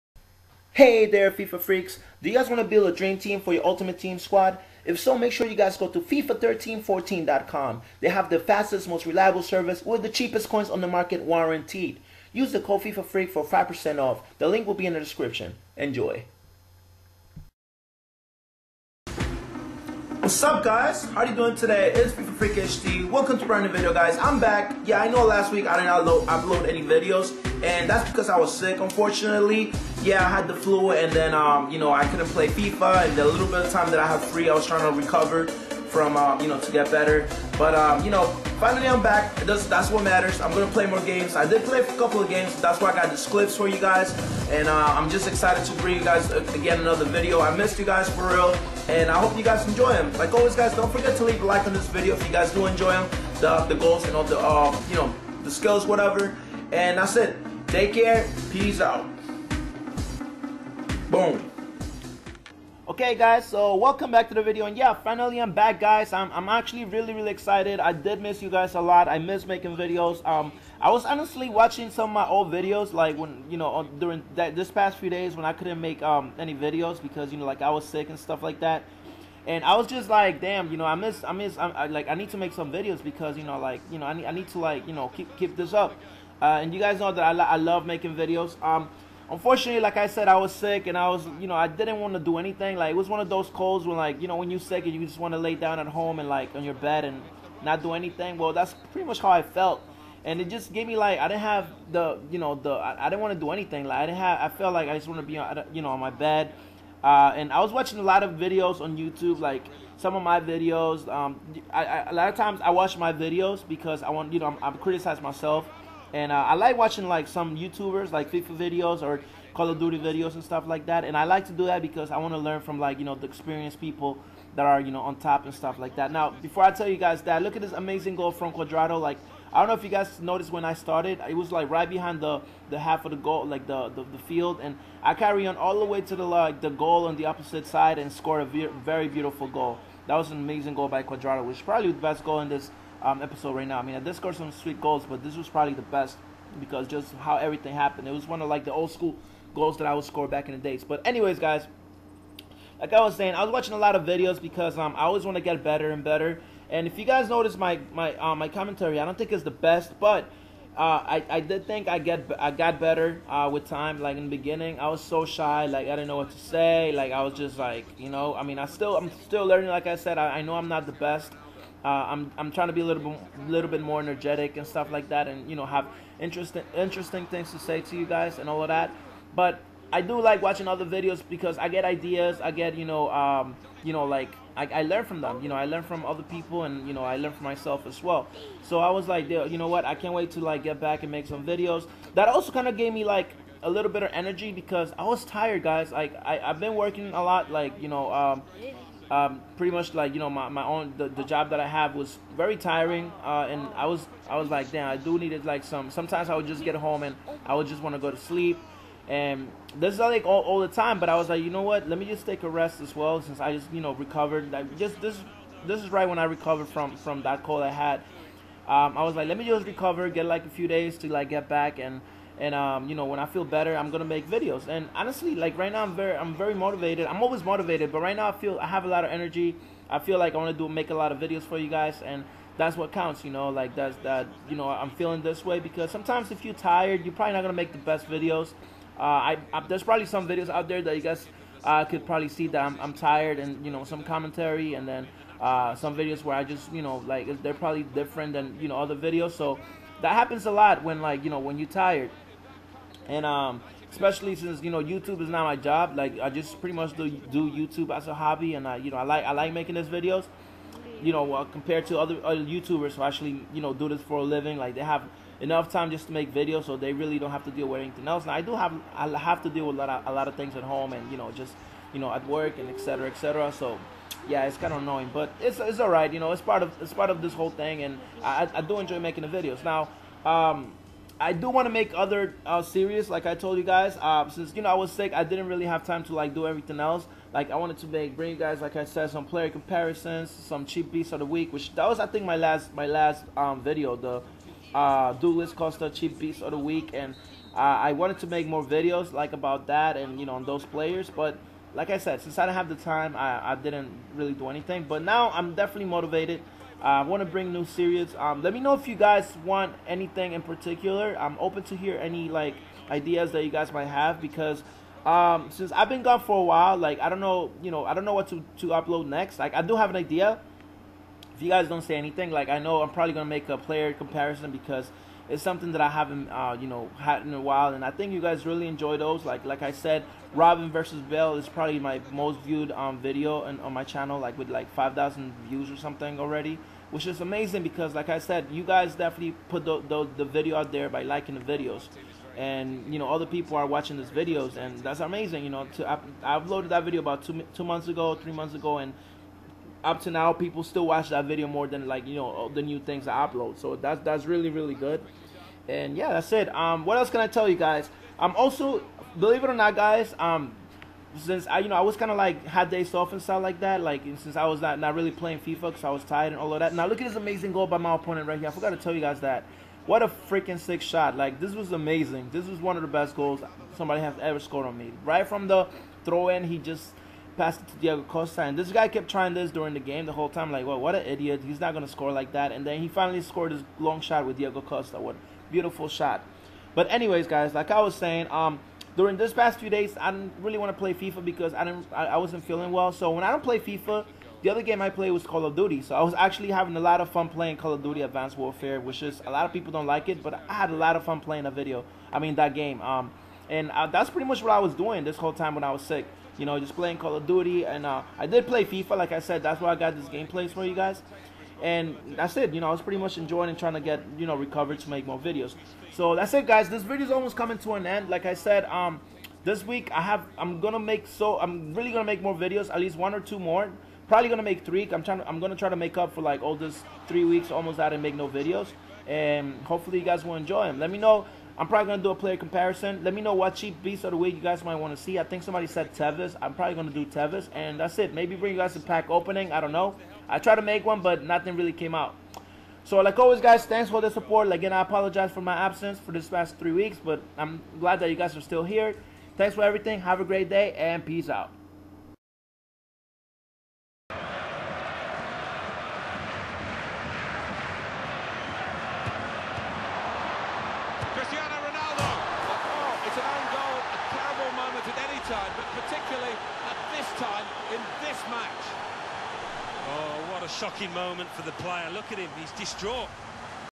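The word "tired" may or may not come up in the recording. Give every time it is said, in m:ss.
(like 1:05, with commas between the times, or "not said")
3:15, 3:56, 4:02, 4:11, 6:06.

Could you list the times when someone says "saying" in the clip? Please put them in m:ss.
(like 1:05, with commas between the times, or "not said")
2:33, 6:27.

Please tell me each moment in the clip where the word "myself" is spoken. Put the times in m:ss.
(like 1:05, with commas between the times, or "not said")
1:55, 3:07.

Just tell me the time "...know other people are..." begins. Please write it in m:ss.
5:42.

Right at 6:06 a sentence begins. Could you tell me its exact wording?
Now look at this amazing goal by my opponent right here.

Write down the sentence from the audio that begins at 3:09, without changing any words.
I can't wait to like get back and make some videos.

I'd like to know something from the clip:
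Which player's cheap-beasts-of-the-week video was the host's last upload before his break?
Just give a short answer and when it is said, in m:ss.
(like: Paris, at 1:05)
Douglas Costa, at 4:55.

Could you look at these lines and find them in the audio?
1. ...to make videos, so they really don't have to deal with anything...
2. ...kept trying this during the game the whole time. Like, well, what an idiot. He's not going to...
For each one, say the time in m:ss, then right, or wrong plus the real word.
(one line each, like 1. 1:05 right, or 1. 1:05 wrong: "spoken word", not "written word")
1. 4:26 right
2. 6:18 right.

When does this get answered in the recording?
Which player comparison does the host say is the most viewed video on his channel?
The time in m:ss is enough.
5:30.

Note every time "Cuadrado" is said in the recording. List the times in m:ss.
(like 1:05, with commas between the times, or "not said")
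2:08, 2:21.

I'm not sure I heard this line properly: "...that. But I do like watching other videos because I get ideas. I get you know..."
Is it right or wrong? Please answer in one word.
right.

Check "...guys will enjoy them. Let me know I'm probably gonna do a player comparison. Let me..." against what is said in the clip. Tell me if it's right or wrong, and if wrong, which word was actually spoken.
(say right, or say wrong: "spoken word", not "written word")
right.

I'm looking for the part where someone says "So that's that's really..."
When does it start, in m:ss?
5:53.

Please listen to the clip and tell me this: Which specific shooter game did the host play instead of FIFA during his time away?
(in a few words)
Call of Duty Advanced Warfare.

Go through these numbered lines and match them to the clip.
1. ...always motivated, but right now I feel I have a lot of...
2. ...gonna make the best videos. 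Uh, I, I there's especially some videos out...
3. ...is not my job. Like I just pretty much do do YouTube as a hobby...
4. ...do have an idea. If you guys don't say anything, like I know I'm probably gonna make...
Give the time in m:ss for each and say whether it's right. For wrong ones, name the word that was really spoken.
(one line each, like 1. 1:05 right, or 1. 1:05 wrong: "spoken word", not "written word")
1. 3:47 right
2. 3:57 wrong: "probably", not "especially"
3. 4:15 right
4. 5:19 right.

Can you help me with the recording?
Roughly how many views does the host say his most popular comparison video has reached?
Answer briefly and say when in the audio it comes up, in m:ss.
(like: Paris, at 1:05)
5,000, at 5:34.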